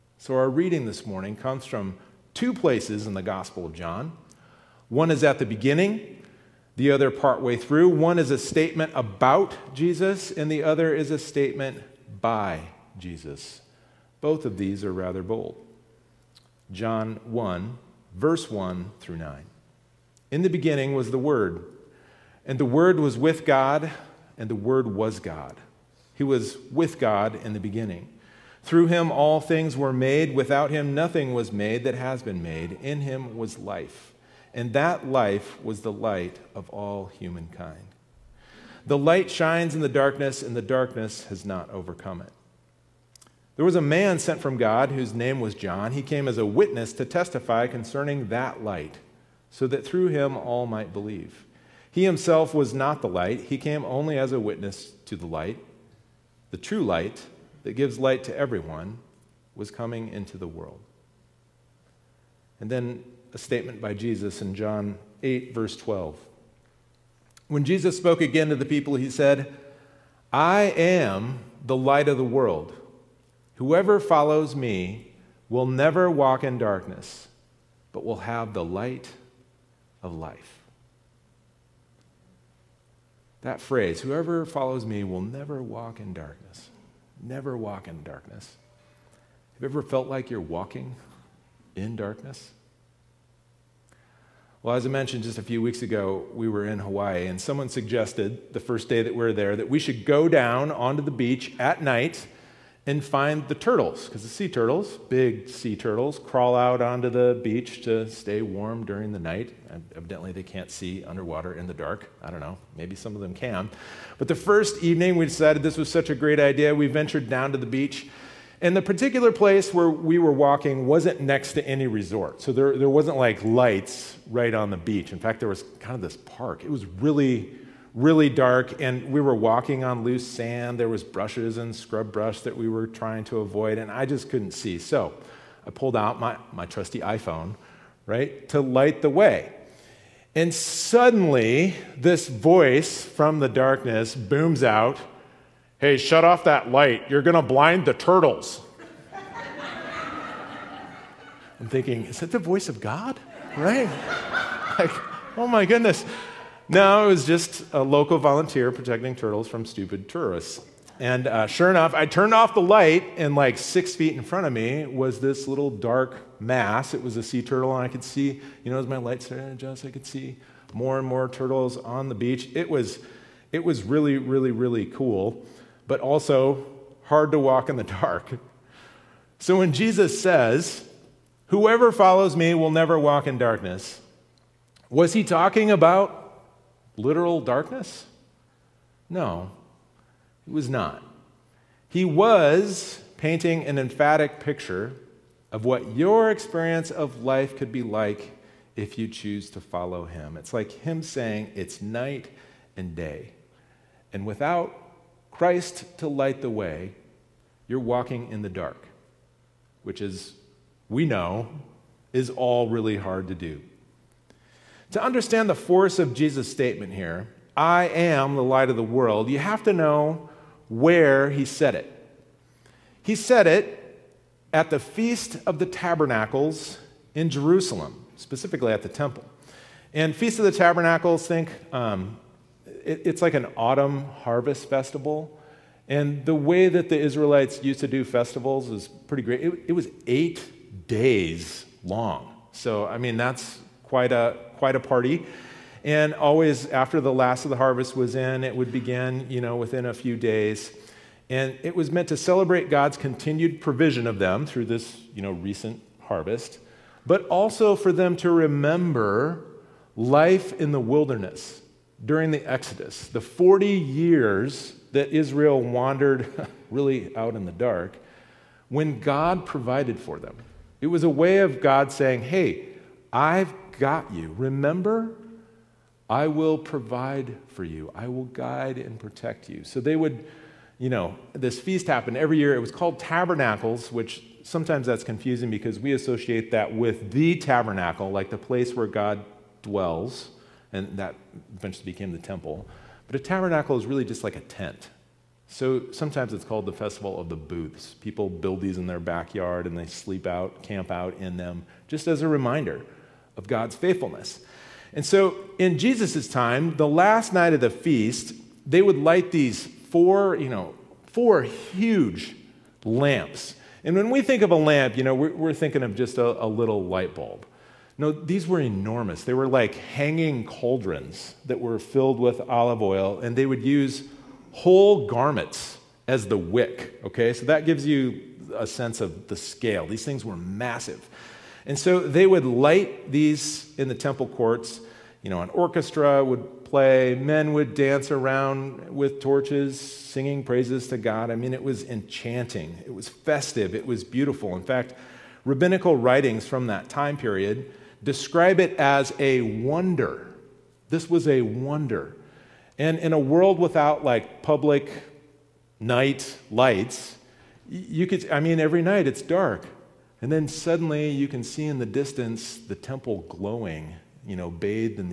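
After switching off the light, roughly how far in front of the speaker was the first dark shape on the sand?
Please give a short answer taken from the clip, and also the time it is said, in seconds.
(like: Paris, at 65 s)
6 feet, at 163 s.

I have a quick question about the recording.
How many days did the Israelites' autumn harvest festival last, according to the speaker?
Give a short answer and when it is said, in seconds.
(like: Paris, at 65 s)
8, at 240 s.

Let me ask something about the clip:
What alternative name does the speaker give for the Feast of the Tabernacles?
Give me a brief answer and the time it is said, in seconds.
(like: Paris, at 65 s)
Festival of the Booths, at 296 s.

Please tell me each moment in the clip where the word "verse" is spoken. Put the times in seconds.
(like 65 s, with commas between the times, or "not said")
18 s, 65 s.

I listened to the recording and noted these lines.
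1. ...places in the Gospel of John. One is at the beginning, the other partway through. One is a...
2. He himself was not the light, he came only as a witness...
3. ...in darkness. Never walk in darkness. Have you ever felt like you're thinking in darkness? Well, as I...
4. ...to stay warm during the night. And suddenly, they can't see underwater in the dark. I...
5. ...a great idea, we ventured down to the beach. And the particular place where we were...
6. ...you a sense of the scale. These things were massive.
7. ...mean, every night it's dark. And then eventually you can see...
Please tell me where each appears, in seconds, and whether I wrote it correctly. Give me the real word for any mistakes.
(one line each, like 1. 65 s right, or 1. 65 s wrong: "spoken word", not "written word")
1. 2 s right
2. 51 s right
3. 86 s wrong: "walking", not "thinking"
4. 107 s wrong: "evidently", not "suddenly"
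5. 116 s right
6. 327 s right
7. 358 s wrong: "suddenly", not "eventually".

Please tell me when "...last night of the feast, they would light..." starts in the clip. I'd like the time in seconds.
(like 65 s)
306 s.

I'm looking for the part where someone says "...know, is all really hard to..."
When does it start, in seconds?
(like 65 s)
211 s.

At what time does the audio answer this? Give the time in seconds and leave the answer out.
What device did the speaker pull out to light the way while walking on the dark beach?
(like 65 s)
137 s.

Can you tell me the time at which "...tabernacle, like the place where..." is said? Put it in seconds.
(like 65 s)
287 s.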